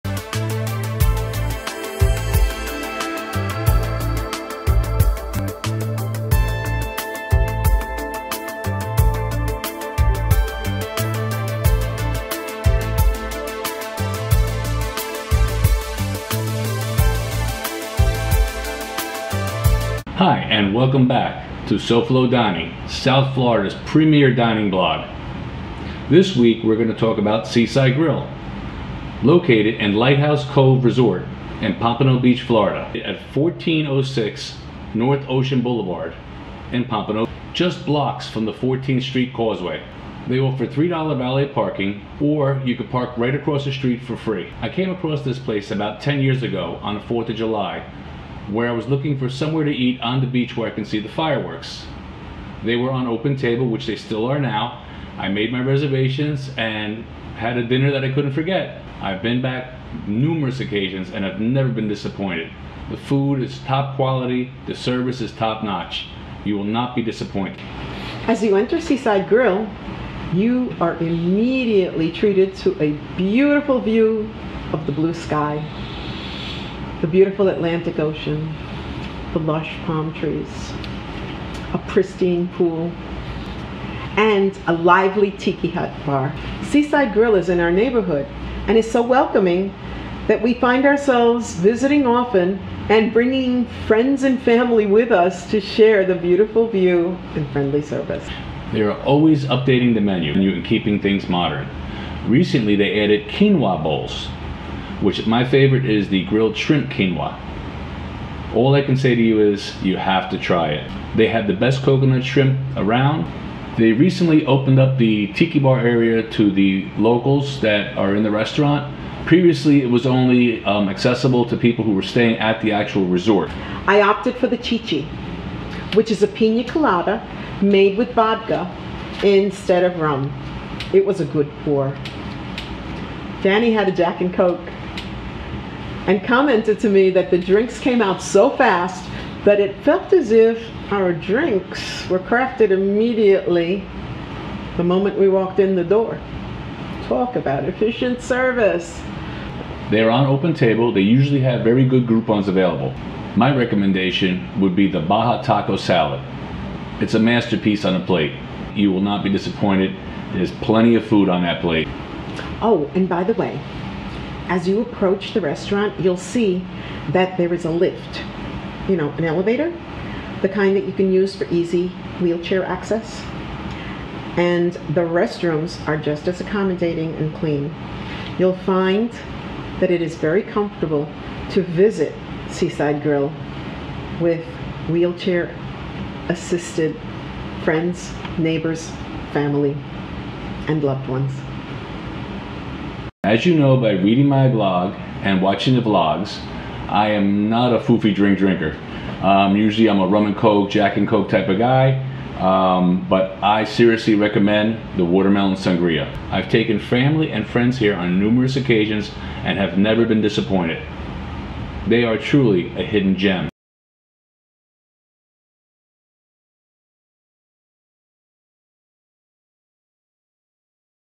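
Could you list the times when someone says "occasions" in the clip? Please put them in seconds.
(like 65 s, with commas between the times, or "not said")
60 s, 208 s.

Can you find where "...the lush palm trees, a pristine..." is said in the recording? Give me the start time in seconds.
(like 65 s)
79 s.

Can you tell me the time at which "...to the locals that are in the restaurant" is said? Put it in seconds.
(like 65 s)
116 s.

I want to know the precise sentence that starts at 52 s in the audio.
They were on open table, which they still are now.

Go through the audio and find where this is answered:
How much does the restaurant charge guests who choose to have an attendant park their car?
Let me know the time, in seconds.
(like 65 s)
40 s.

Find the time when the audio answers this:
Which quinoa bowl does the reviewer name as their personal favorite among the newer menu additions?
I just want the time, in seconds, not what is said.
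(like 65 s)
106 s.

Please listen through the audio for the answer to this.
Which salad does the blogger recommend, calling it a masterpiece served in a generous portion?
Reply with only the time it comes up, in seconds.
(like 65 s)
155 s.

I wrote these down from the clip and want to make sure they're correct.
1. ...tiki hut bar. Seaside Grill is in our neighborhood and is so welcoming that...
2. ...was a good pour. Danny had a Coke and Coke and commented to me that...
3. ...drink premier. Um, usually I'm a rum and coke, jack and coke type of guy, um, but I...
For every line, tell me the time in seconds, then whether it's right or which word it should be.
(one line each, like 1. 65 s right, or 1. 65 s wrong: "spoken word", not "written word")
1. 85 s right
2. 131 s wrong: "Jack", not "Coke"
3. 198 s wrong: "drinker", not "premier".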